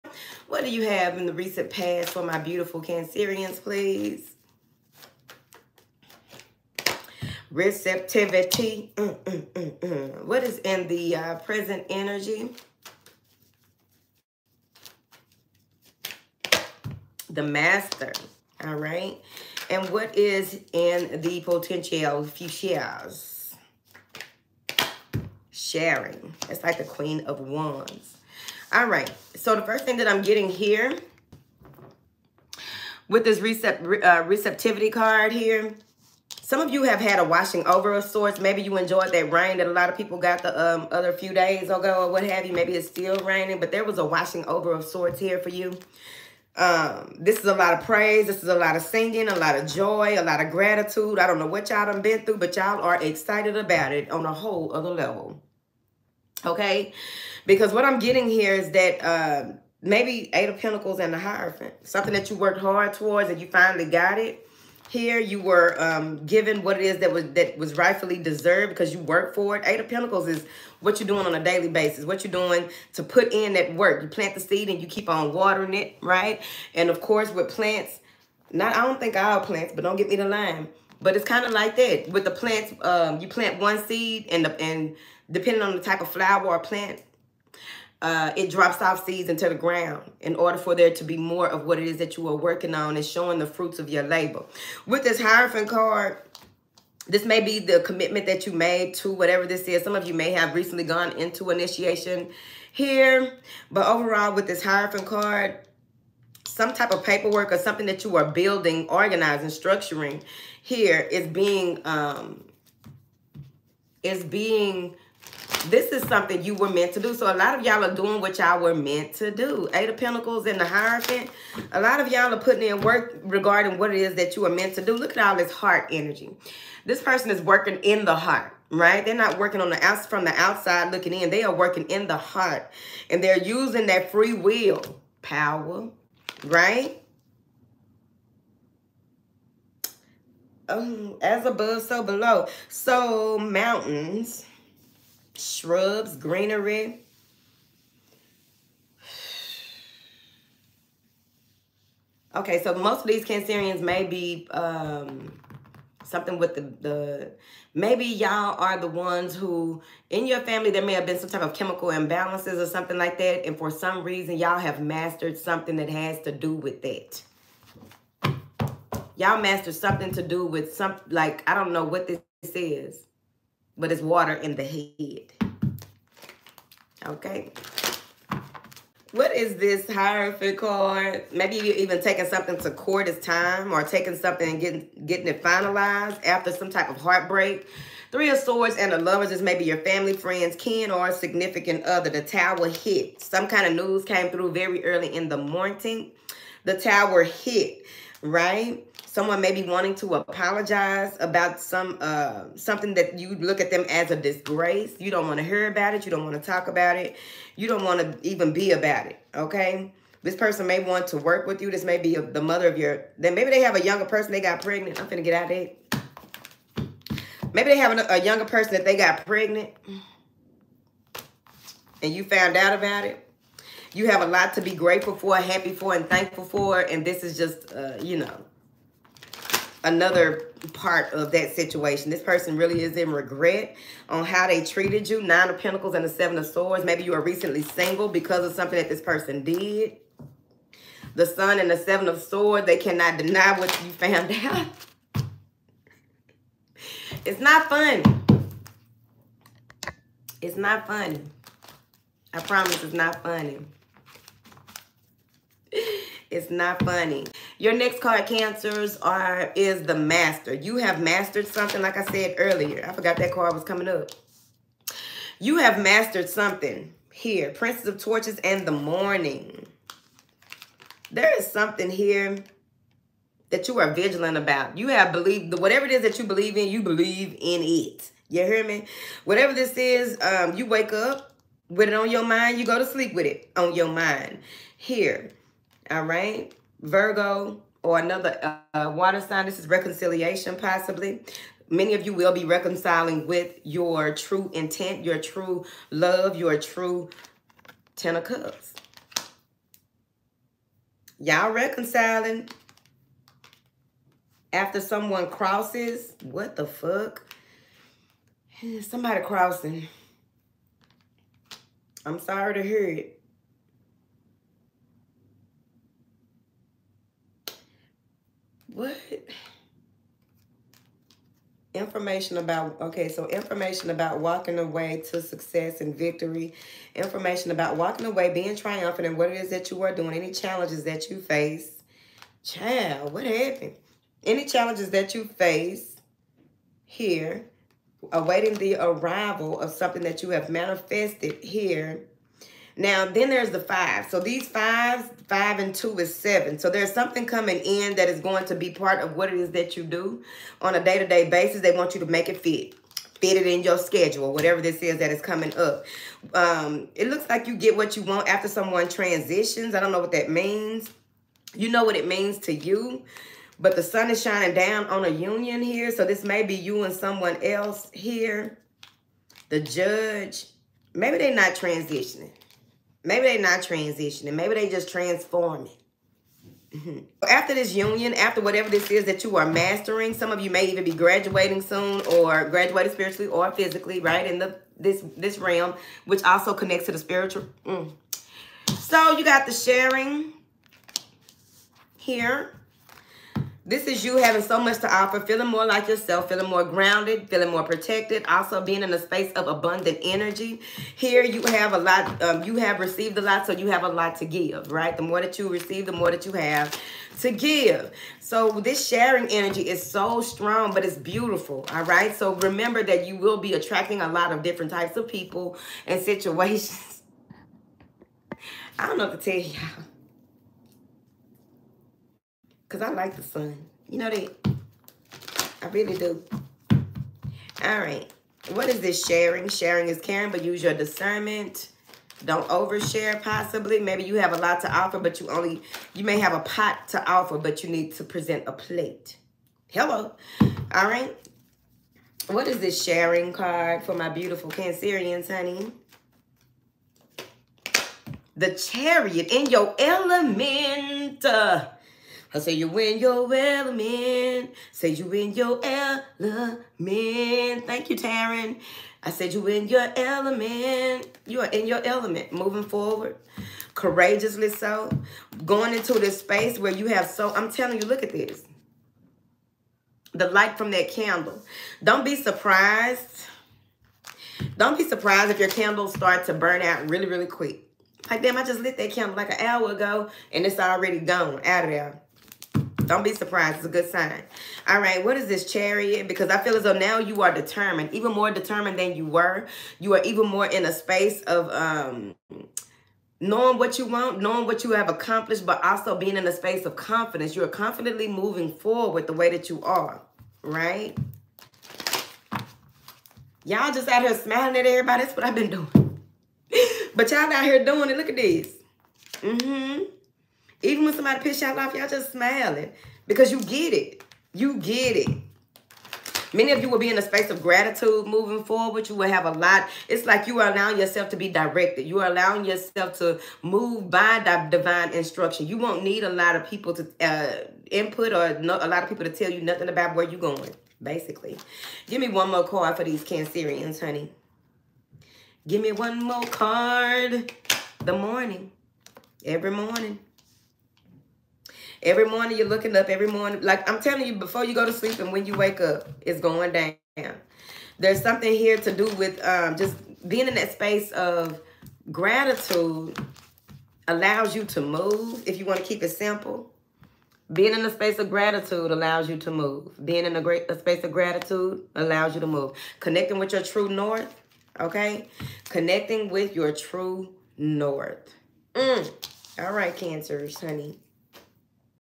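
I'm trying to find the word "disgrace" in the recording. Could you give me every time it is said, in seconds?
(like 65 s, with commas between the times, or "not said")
204 s.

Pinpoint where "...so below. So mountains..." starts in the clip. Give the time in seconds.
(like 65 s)
141 s.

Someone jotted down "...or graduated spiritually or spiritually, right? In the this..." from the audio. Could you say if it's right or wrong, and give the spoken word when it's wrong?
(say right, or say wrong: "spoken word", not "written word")
wrong: "physically", not "spiritually".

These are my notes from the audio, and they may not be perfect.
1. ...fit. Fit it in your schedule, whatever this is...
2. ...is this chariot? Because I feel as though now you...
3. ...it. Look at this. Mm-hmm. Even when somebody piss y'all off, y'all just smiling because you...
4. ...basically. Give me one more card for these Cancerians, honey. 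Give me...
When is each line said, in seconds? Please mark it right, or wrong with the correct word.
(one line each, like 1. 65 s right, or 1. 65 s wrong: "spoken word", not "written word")
1. 352 s right
2. 485 s right
3. 507 s right
4. 530 s right.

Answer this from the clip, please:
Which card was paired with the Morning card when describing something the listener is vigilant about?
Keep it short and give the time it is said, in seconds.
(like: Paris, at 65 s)
Princess of Torches, at 267 s.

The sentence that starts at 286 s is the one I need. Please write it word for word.
Virgo or another uh, water sign.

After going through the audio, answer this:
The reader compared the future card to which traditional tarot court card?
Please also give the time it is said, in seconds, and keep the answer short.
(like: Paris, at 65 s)
Queen of Wands, at 26 s.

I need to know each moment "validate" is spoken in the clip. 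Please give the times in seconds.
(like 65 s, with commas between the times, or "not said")
not said.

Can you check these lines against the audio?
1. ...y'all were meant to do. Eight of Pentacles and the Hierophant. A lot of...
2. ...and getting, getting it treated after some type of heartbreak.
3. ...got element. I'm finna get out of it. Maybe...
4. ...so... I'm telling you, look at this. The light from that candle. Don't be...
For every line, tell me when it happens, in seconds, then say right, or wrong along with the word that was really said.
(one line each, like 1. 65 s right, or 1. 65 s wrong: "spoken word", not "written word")
1. 118 s right
2. 184 s wrong: "finalized", not "treated"
3. 214 s wrong: "pregnant", not "element"
4. 467 s right.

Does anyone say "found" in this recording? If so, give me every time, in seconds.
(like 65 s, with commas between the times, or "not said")
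222 s, 243 s.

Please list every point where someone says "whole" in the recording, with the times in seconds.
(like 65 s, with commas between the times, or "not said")
54 s.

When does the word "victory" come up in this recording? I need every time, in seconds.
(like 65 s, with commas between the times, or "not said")
325 s.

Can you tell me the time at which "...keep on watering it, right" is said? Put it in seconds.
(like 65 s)
74 s.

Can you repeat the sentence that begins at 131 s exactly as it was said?
They are working in the heart.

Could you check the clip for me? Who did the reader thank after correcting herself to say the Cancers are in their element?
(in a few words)
Taryn.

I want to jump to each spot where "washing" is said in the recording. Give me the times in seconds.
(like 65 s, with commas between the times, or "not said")
37 s, 44 s.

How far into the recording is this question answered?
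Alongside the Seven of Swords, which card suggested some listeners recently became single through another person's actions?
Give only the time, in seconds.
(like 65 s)
235 s.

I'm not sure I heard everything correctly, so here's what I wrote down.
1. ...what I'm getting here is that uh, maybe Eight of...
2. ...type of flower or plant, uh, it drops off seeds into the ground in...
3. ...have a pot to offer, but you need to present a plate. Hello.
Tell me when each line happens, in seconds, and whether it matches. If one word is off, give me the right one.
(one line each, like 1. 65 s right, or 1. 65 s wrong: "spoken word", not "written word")
1. 57 s right
2. 85 s right
3. 436 s right.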